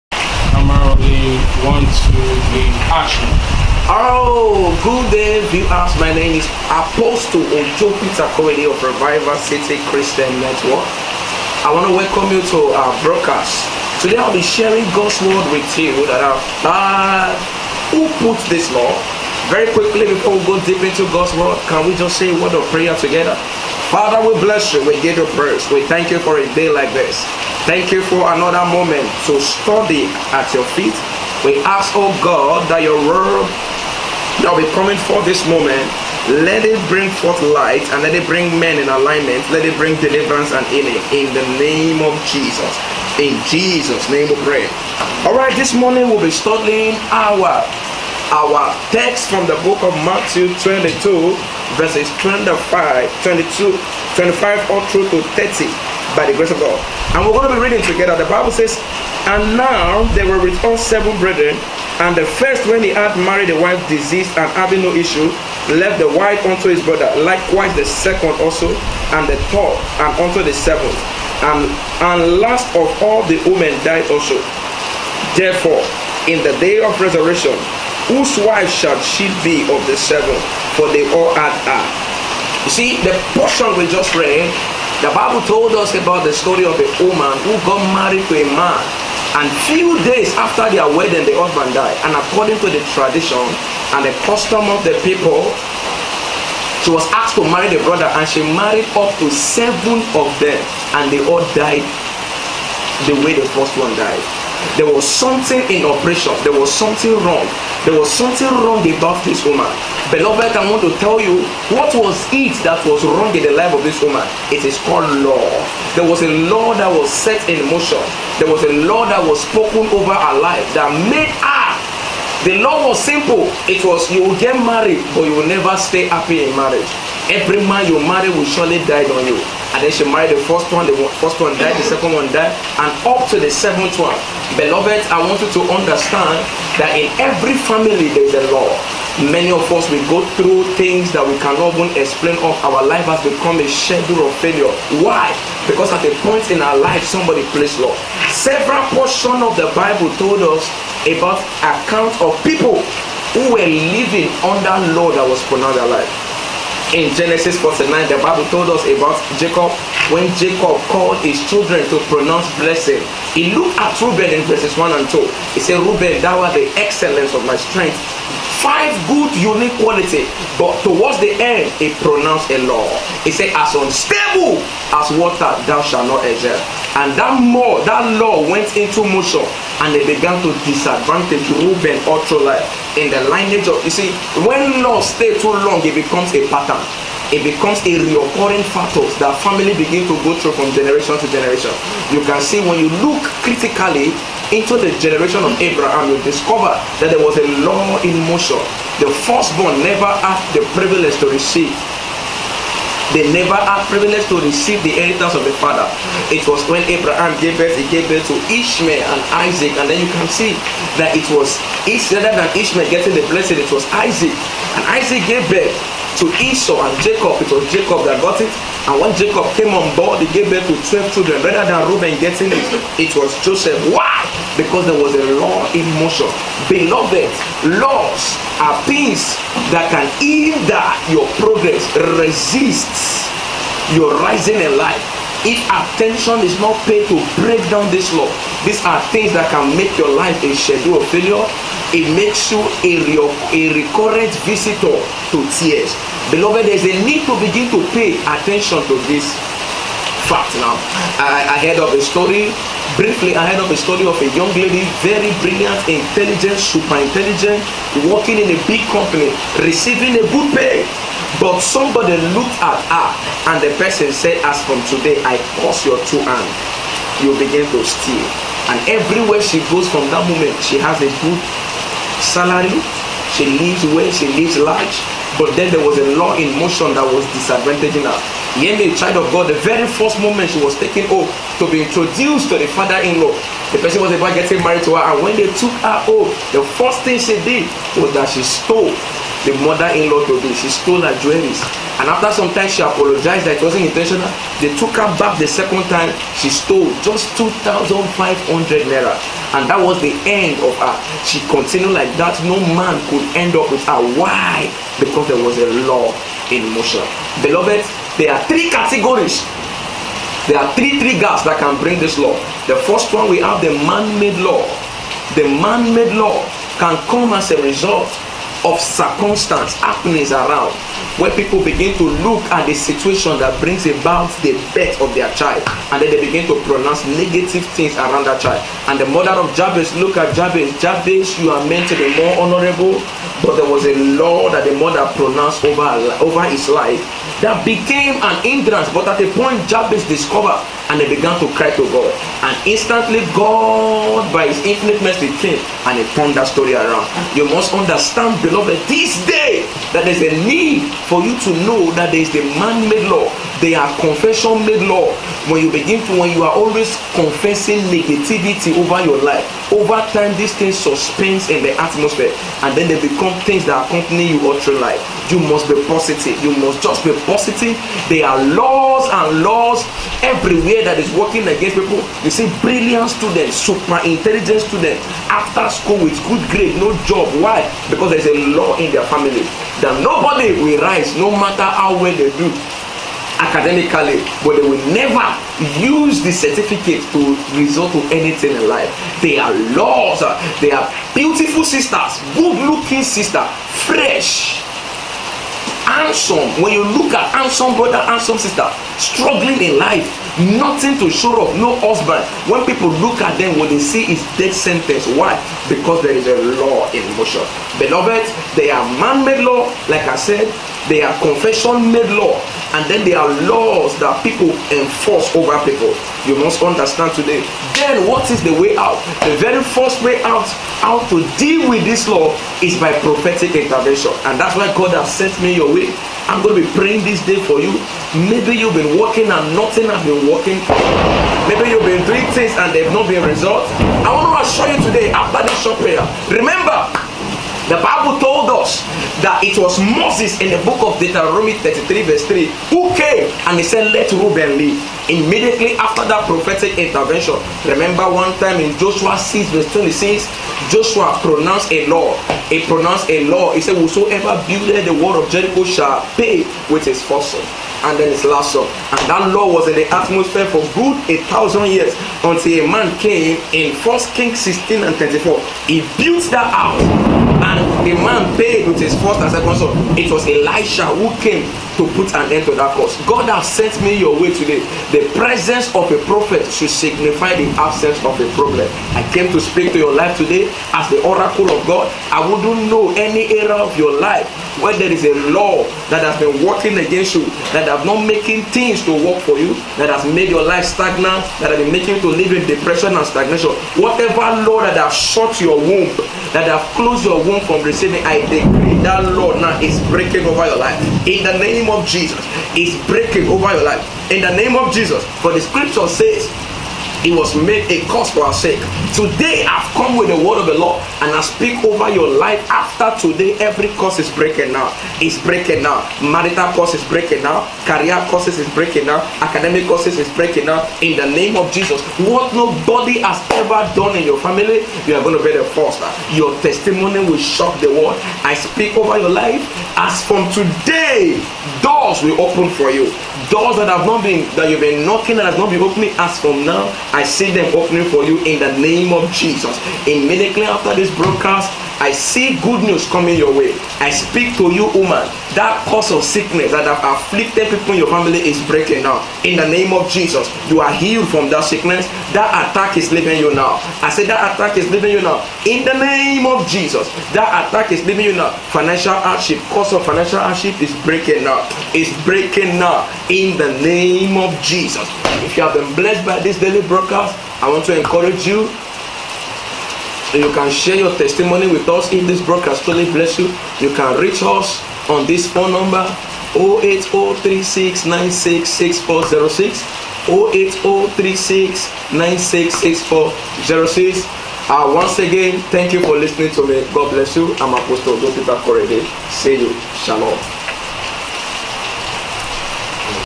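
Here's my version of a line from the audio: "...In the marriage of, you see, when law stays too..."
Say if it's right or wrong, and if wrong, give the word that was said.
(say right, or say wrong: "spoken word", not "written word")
wrong: "lineage", not "marriage".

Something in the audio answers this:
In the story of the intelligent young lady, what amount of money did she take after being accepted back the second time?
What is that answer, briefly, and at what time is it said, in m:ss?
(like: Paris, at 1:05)
2,500 naira, at 4:57.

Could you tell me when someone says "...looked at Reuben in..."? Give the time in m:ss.
2:43.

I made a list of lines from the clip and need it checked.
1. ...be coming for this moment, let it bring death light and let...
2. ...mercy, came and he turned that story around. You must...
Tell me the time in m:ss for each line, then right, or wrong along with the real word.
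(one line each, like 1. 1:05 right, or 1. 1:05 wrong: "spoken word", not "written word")
1. 0:34 wrong: "forth", not "death"
2. 5:45 right.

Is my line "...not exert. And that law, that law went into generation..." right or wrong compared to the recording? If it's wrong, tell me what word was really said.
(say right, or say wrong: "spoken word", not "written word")
wrong: "motion", not "generation".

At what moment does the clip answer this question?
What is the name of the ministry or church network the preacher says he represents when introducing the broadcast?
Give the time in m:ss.
0:08.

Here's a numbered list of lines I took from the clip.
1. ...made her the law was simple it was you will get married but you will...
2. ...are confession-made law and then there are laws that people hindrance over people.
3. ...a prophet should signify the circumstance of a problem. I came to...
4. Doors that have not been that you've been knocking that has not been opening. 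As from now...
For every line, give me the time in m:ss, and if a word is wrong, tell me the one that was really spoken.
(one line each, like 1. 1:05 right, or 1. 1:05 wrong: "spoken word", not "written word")
1. 2:01 right
2. 6:51 wrong: "enforce", not "hindrance"
3. 7:55 wrong: "absence", not "circumstance"
4. 8:53 right.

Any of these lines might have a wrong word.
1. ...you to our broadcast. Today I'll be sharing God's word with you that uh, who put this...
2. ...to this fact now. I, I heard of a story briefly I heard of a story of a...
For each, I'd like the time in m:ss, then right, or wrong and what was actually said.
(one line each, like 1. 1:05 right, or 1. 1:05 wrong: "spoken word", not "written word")
1. 0:12 right
2. 4:08 right.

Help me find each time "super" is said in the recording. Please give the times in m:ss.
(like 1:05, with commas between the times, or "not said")
4:16, 6:13.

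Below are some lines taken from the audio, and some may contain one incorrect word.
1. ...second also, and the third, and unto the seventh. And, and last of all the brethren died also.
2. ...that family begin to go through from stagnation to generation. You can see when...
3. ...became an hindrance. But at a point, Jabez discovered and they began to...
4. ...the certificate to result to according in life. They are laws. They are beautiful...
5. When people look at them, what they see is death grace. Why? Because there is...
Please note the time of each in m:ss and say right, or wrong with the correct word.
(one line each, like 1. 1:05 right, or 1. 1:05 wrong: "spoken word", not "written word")
1. 1:07 wrong: "women", not "brethren"
2. 3:09 wrong: "generation", not "stagnation"
3. 5:37 right
4. 6:26 wrong: "anything", not "according"
5. 6:42 wrong: "sentence", not "grace".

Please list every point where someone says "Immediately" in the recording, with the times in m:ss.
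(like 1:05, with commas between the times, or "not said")
7:25, 8:59.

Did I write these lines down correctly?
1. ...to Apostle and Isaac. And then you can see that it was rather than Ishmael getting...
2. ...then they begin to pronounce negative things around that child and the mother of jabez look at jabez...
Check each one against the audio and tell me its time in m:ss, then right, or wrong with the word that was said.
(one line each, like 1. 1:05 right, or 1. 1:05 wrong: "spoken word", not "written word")
1. 3:28 wrong: "Ishmael", not "Apostle"
2. 5:26 right.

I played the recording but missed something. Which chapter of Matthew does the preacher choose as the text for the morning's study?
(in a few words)
22.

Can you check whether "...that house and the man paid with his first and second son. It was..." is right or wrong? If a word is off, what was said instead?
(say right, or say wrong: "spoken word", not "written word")
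right.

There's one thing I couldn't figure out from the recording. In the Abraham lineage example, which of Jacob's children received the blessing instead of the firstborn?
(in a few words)
Joseph.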